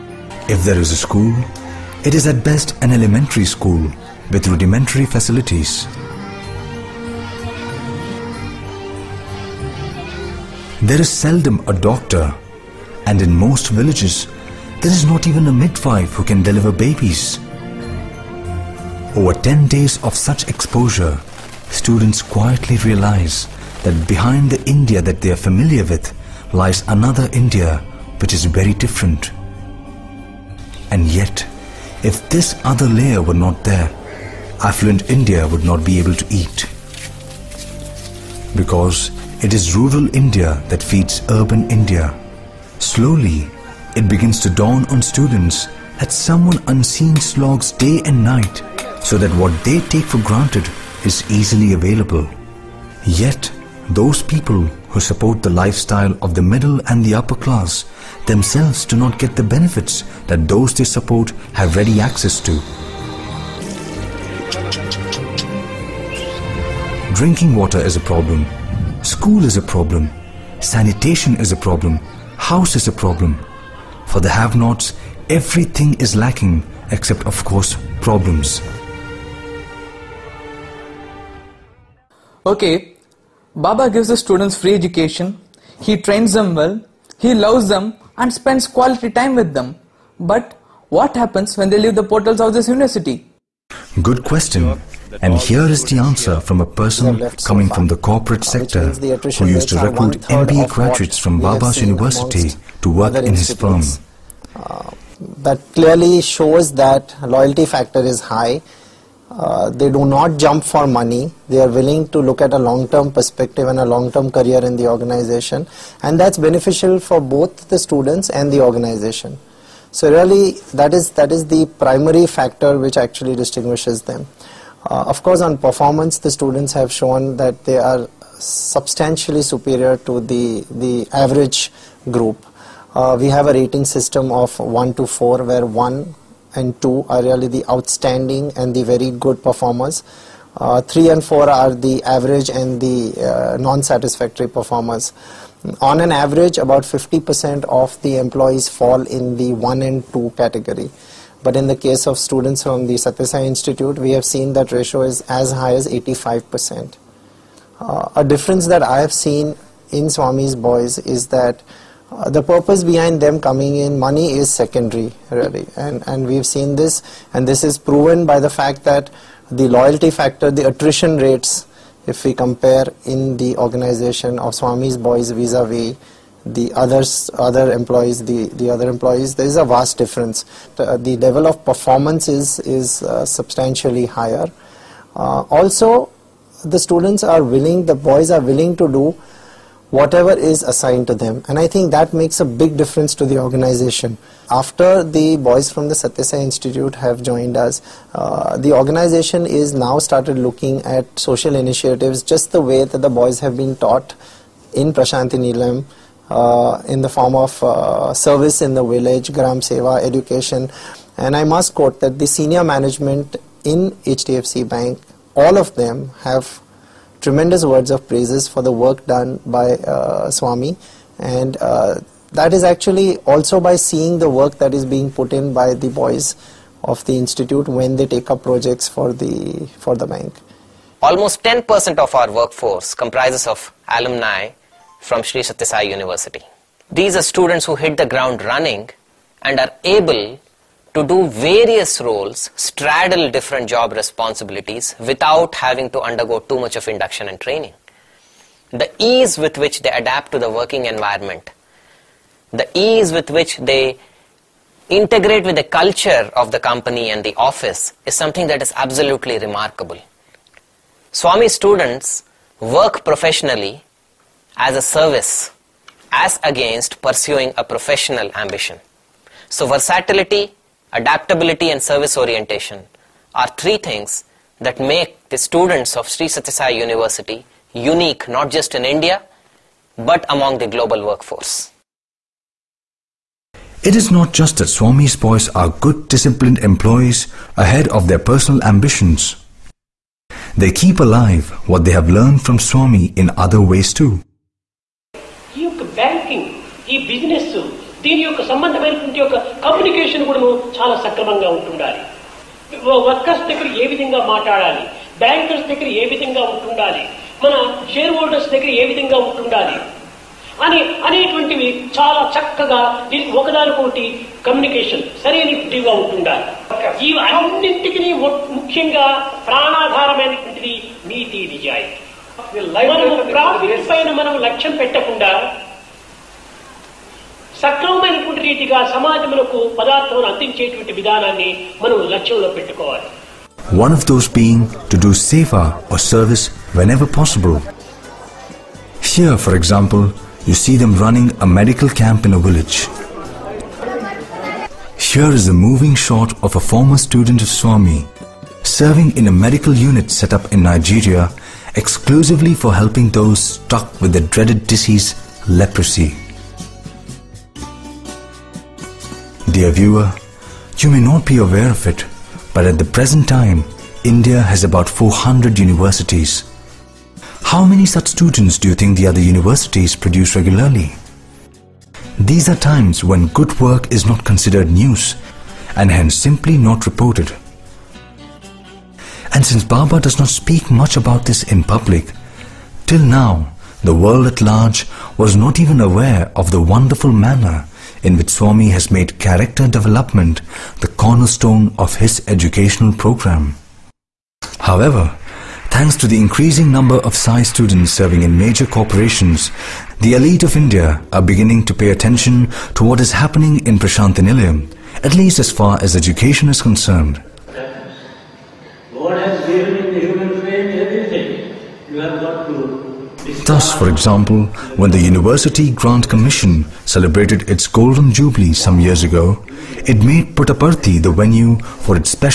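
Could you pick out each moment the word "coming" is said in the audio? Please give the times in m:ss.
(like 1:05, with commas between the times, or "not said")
1:37, 2:43.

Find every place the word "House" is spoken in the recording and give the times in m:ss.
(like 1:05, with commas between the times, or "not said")
1:12.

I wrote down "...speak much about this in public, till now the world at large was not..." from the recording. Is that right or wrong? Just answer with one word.
right.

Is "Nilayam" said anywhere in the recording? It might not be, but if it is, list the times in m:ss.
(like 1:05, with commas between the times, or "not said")
3:25, 6:44.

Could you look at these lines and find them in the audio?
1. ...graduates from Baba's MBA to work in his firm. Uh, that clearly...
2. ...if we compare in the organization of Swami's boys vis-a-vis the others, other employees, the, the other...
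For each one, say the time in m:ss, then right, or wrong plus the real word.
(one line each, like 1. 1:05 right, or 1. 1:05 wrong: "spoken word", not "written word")
1. 1:40 wrong: "University", not "MBA"
2. 2:52 right.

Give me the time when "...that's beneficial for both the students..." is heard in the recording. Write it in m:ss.
1:56.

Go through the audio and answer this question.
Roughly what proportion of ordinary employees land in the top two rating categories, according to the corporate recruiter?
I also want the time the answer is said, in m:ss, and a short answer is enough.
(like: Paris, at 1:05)
50%, at 2:26.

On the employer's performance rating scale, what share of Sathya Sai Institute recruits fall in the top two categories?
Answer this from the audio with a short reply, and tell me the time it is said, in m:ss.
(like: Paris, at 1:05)
85%, at 2:35.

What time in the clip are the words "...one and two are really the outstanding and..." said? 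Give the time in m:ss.
2:15.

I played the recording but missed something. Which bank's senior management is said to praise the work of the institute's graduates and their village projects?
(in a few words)
HDFC Bank.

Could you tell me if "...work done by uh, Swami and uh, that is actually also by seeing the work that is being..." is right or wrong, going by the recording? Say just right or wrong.
right.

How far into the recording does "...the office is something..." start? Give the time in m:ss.
4:17.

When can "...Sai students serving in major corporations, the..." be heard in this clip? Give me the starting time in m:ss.
6:37.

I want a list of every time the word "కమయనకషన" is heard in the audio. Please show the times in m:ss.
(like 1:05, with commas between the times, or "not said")
4:59, 5:14.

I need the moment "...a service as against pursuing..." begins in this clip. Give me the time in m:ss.
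4:24.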